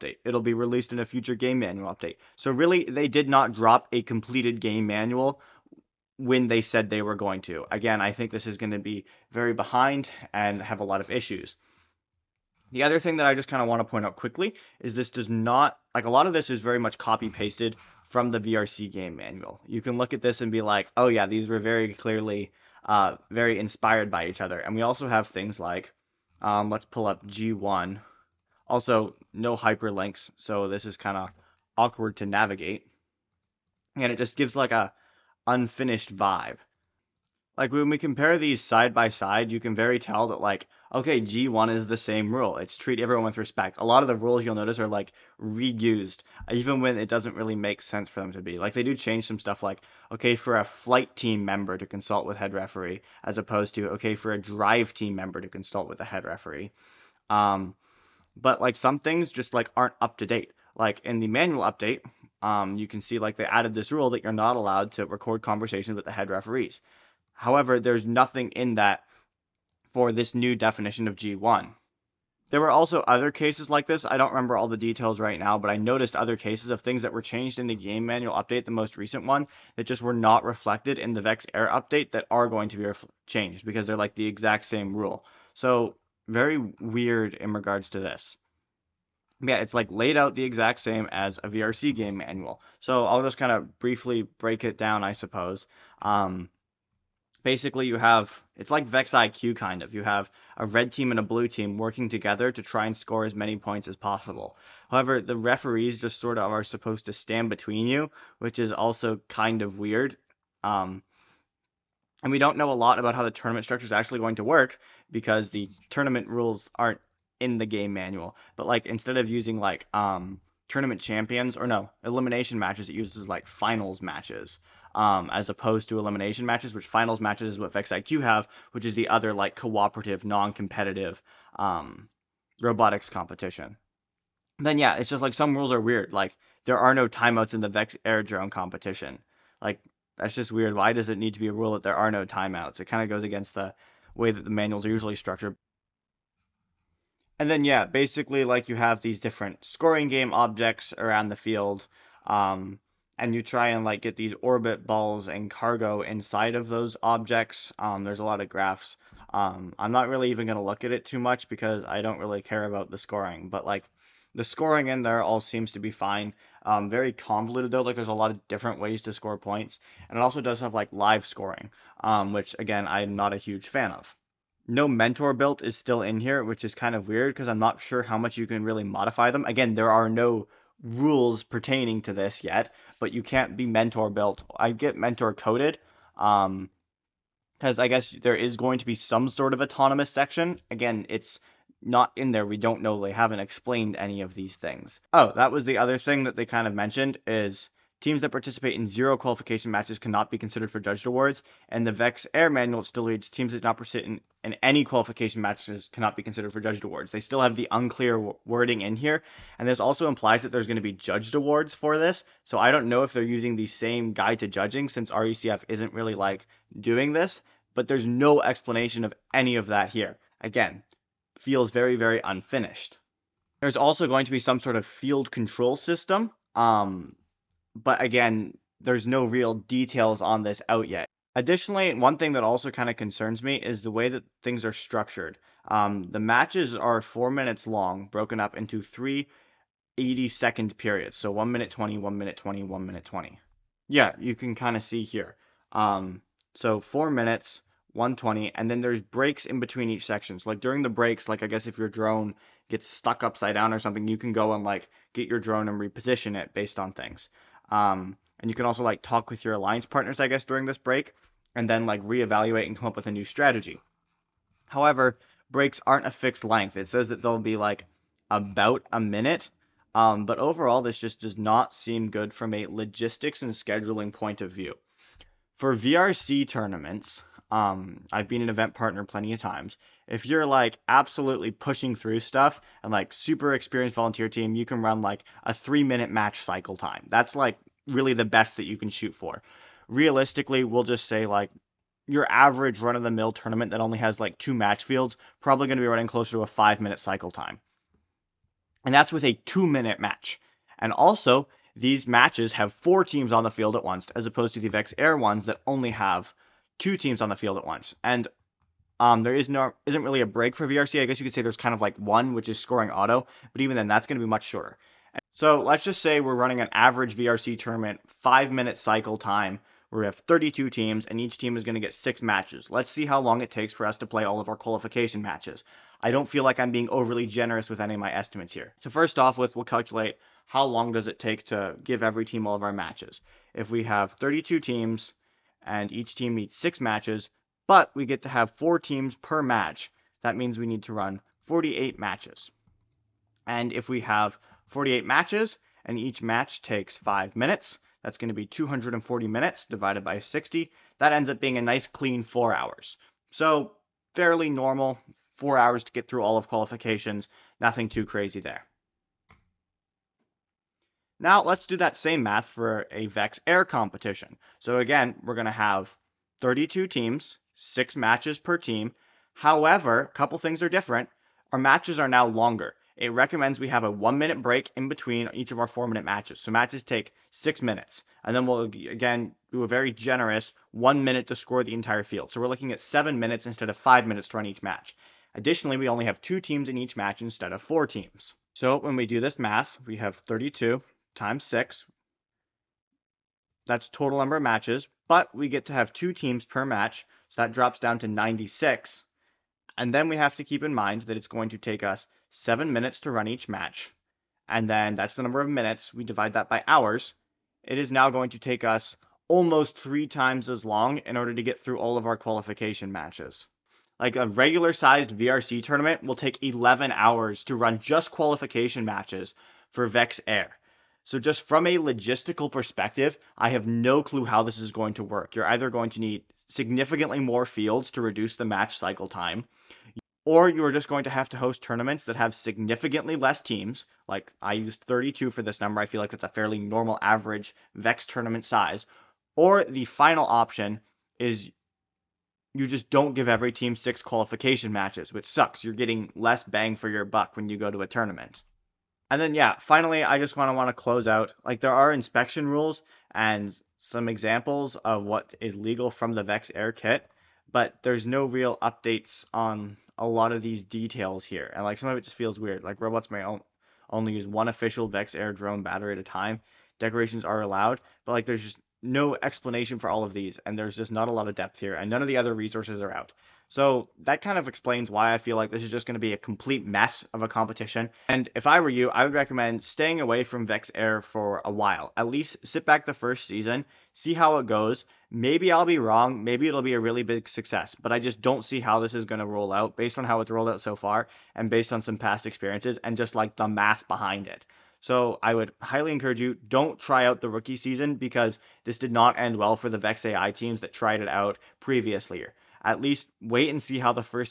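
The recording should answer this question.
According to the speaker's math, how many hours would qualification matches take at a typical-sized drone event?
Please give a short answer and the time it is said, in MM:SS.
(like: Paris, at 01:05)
11 hours, at 06:56.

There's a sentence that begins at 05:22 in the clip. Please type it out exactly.
Let's see how long it takes for us to play all of our qualification matches.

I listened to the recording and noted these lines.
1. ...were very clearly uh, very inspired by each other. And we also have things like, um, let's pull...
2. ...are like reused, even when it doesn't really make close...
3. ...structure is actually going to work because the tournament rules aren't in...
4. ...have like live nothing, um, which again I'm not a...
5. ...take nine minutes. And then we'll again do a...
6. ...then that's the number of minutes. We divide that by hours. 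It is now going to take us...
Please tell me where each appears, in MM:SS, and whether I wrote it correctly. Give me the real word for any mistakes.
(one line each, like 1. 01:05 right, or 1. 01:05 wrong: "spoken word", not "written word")
1. 00:21 right
2. 00:44 wrong: "sense", not "close"
3. 01:53 right
4. 02:50 wrong: "scoring", not "nothing"
5. 06:16 wrong: "six", not "nine"
6. 06:44 right.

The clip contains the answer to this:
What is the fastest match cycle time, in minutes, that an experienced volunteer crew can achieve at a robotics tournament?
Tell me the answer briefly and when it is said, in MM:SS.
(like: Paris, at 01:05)
3 minutes, at 04:45.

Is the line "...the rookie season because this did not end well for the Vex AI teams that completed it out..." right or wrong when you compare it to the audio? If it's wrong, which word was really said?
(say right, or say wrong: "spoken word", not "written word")
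wrong: "tried", not "completed".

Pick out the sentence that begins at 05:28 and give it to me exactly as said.
So first off with, we'll calculate how long does it take to give every team all of our matches.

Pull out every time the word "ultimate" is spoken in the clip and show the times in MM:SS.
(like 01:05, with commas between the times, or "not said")
not said.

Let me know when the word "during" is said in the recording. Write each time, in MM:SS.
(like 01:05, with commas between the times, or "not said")
04:10, 04:20.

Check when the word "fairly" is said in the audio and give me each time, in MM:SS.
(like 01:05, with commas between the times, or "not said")
05:54, 07:16.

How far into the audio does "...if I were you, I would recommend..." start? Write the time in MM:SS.
07:58.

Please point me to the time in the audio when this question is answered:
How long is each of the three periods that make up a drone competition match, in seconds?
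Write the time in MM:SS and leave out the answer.
03:59.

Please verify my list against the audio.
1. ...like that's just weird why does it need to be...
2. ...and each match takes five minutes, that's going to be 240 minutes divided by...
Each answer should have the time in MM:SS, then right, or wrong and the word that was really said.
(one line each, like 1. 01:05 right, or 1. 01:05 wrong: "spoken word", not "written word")
1. 02:19 right
2. 05:45 right.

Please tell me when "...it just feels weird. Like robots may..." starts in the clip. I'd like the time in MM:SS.
07:41.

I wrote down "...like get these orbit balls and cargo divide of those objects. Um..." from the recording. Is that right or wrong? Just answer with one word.
wrong.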